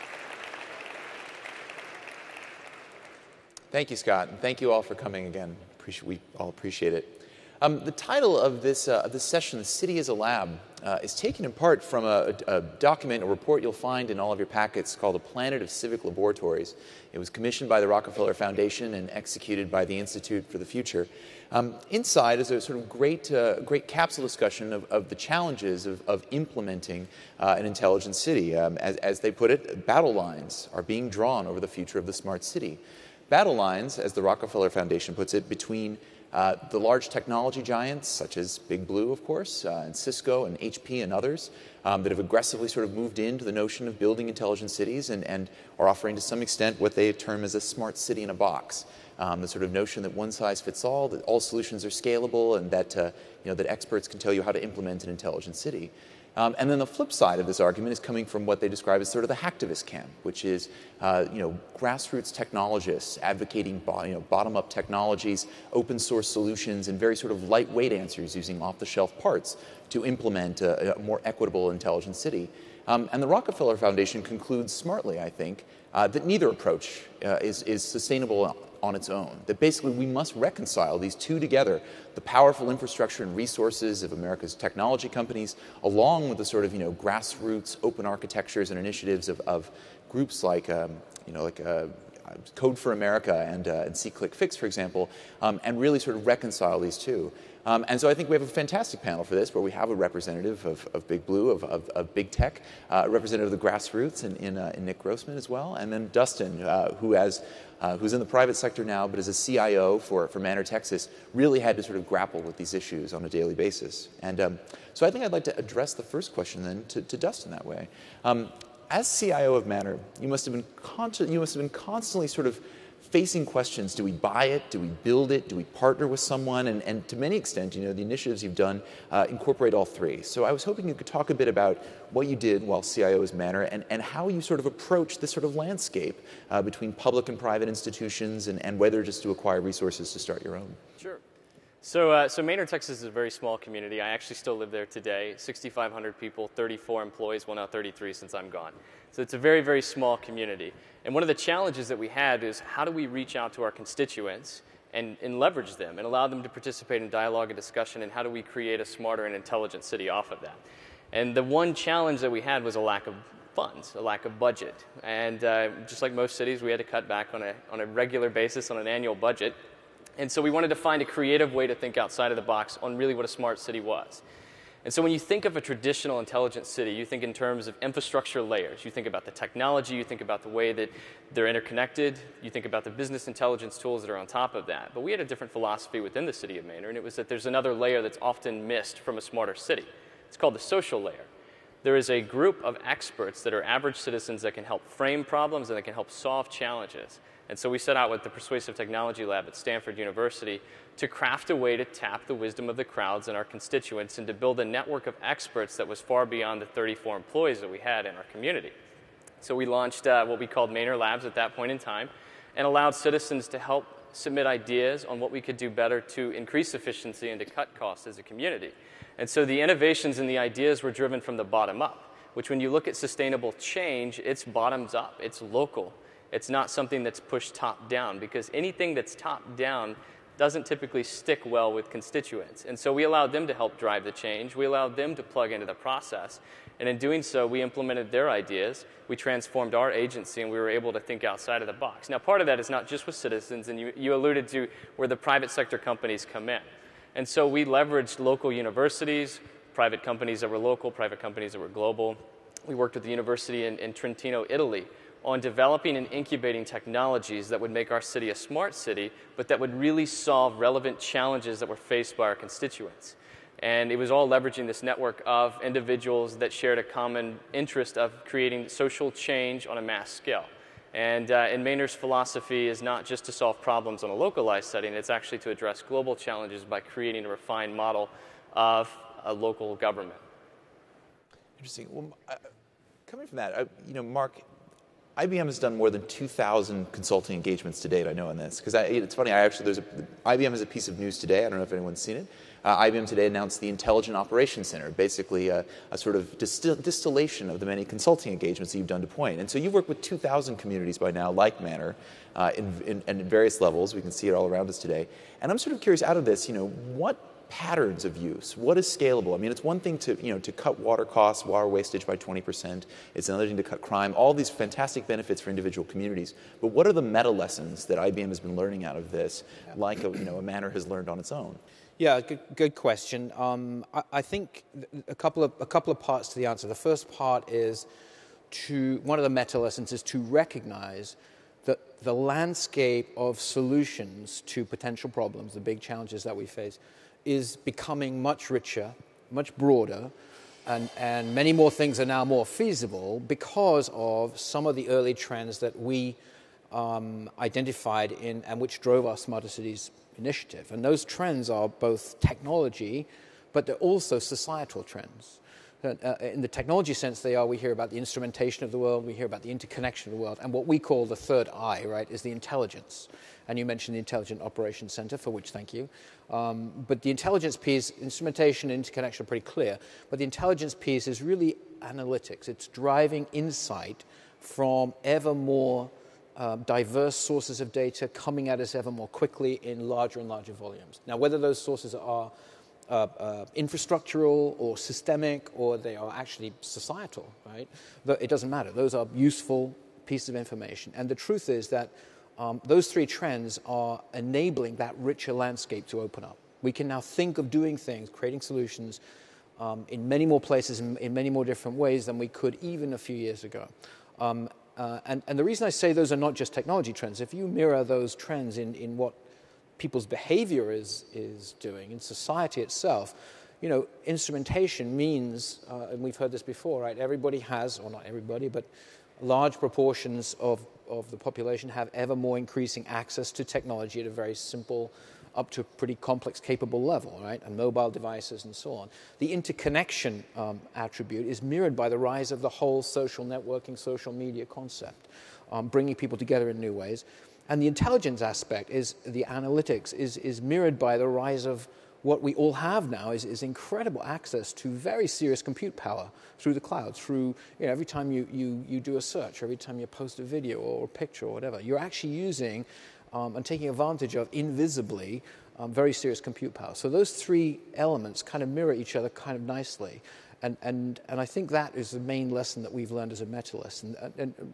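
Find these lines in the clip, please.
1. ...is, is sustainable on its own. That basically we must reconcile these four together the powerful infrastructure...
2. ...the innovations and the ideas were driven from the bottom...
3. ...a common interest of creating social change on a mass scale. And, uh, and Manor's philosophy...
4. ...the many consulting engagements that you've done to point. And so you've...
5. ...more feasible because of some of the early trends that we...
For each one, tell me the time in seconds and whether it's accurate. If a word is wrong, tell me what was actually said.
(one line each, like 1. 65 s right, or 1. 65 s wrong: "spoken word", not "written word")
1. 77 s wrong: "two", not "four"
2. 219 s right
3. 266 s right
4. 297 s right
5. 342 s right.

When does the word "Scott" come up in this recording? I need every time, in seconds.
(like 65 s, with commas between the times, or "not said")
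3 s.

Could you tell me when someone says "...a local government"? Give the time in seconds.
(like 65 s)
279 s.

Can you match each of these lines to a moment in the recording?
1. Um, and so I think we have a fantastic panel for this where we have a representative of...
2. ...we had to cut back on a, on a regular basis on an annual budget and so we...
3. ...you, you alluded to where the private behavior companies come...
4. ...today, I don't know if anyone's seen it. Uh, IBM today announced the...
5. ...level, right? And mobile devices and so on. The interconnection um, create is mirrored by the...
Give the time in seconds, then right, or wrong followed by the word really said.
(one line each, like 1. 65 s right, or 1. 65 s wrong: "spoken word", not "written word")
1. 97 s right
2. 166 s right
3. 243 s wrong: "sector", not "behavior"
4. 291 s right
5. 426 s wrong: "attribute", not "create".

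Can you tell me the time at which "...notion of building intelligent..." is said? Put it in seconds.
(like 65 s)
43 s.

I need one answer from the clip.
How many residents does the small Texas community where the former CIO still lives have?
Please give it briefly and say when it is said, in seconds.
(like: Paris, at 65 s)
6,500, at 145 s.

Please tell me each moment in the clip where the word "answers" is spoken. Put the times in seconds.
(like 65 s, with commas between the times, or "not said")
67 s, 326 s.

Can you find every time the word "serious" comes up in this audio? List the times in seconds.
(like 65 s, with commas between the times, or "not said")
445 s, 455 s.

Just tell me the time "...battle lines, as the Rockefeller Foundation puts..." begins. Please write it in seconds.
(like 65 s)
33 s.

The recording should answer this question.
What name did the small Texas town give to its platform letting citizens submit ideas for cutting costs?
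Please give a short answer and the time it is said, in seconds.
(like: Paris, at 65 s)
Manor Labs, at 210 s.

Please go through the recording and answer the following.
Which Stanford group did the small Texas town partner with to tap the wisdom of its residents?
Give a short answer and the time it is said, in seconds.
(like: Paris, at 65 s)
Persuasive Technology Lab, at 198 s.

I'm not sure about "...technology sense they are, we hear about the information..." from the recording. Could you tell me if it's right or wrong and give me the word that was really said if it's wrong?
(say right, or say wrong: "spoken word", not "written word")
wrong: "instrumentation", not "information".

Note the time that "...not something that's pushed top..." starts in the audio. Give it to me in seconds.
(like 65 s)
226 s.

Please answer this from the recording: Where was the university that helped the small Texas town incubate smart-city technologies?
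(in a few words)
Trentino, Italy.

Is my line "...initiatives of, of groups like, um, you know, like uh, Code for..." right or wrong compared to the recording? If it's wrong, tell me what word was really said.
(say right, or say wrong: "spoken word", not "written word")
right.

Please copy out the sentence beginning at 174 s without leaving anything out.
And so when you think of a traditional intelligent city, you think in terms of infrastructure layers.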